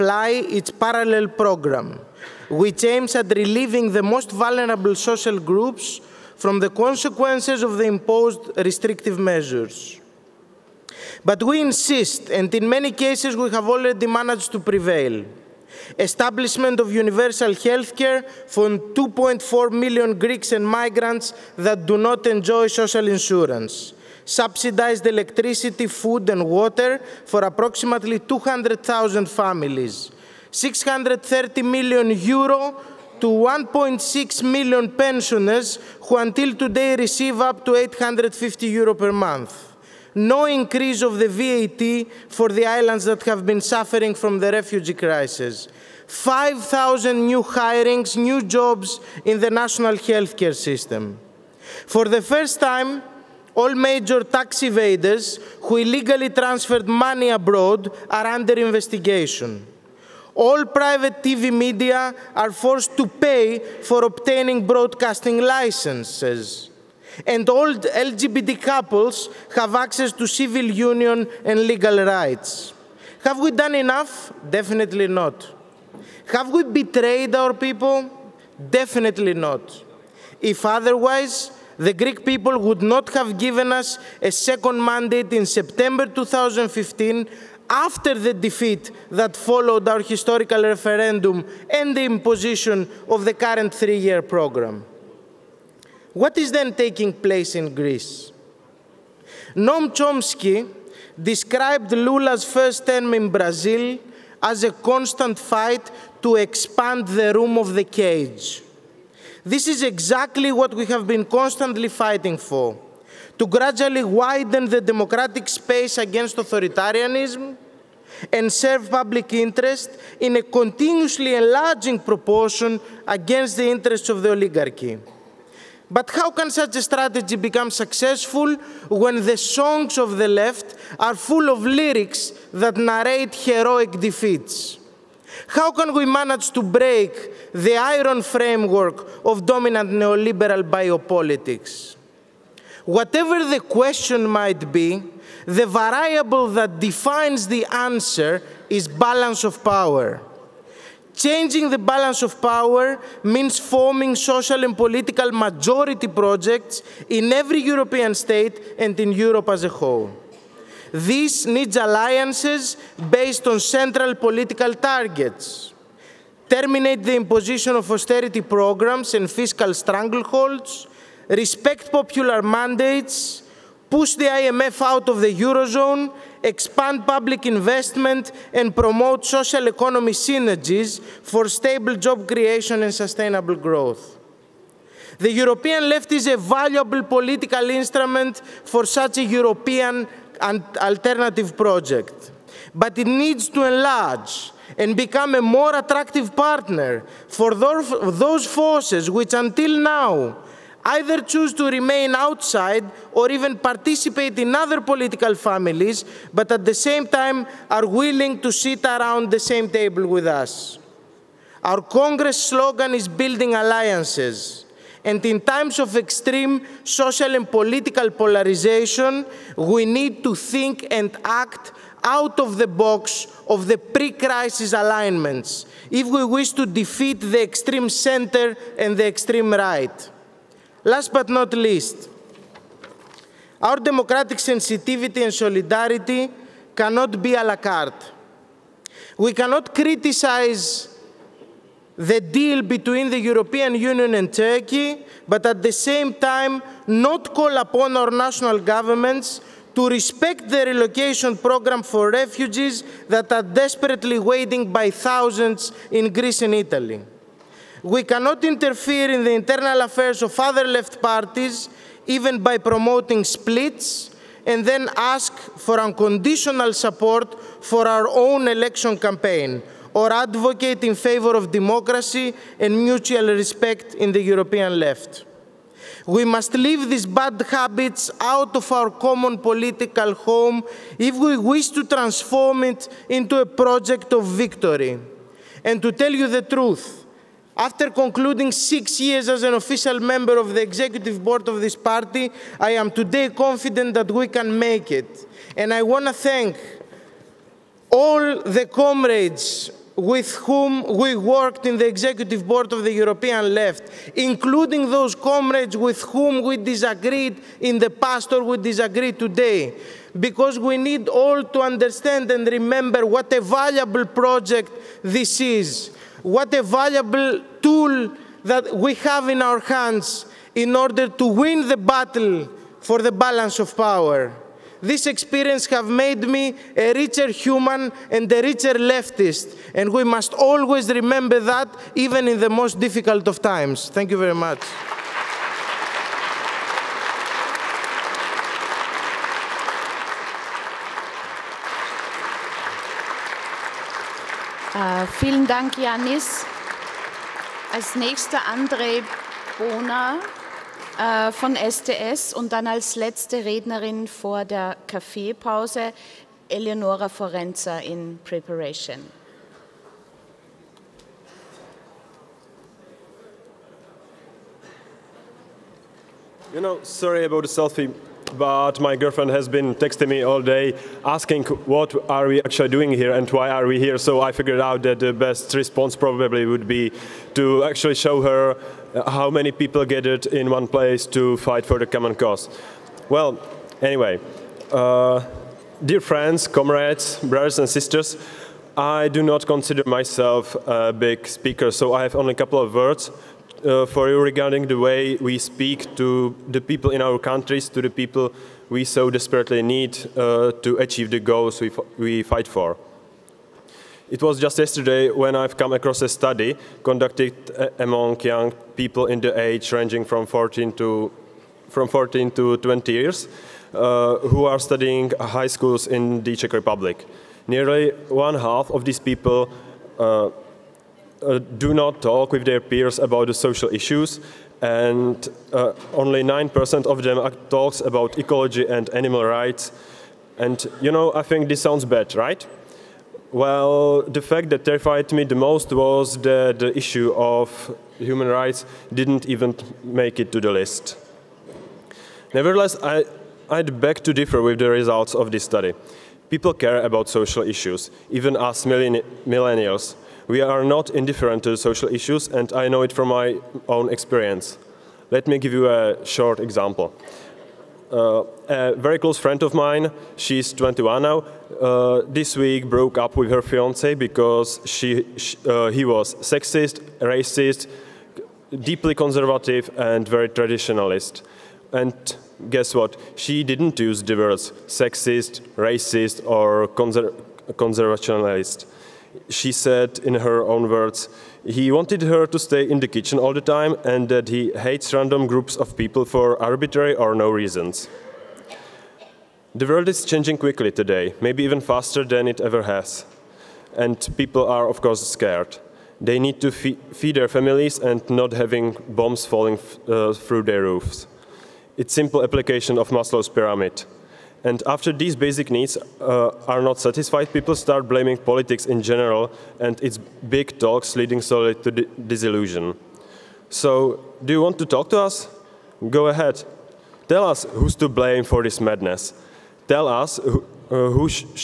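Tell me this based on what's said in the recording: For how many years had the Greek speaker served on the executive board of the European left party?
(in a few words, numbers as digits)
six years.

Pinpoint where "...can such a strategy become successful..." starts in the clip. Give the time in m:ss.
2:06.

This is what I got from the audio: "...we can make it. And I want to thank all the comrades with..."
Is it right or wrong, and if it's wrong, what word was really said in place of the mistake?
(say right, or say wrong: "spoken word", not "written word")
right.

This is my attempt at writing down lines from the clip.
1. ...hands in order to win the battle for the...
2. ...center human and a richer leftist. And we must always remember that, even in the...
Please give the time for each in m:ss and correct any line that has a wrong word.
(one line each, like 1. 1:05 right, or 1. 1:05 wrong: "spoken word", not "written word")
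1. 5:19 right
2. 5:26 wrong: "richer", not "center".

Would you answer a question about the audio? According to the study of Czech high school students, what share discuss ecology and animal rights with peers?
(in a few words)
9%.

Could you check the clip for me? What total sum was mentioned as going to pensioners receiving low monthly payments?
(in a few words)
630 million euro.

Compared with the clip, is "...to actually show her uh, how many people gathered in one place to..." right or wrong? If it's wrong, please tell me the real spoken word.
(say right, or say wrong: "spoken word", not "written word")
right.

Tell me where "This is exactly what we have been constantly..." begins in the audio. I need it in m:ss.
1:49.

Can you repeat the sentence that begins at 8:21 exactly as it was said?
It's simple application of Maslow's pyramid.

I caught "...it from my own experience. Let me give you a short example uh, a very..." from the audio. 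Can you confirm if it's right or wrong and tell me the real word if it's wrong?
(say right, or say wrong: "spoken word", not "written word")
right.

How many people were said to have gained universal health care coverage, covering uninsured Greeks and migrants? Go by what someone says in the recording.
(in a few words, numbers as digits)
2.4 million.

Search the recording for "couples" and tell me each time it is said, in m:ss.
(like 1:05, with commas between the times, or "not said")
1:08, 6:32.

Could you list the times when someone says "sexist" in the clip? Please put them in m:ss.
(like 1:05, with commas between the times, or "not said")
7:46, 7:54.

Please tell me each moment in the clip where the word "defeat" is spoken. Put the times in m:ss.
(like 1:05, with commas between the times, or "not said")
1:28, 2:13, 3:46.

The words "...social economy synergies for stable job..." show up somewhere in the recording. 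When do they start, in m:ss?
2:59.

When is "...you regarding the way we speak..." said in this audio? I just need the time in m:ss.
6:34.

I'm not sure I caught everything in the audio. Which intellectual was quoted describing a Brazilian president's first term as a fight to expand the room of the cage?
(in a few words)
Noam Chomsky.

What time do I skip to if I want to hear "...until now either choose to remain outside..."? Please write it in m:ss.
3:19.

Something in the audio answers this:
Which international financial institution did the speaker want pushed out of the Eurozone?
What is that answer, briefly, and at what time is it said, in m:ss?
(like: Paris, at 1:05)
IMF, at 2:54.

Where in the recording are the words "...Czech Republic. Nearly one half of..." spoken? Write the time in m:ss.
6:56.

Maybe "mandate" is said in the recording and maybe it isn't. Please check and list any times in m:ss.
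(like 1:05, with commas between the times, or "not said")
1:24, 2:52.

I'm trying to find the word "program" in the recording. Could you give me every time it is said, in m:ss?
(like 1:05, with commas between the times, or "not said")
0:01, 1:34, 2:48, 4:11.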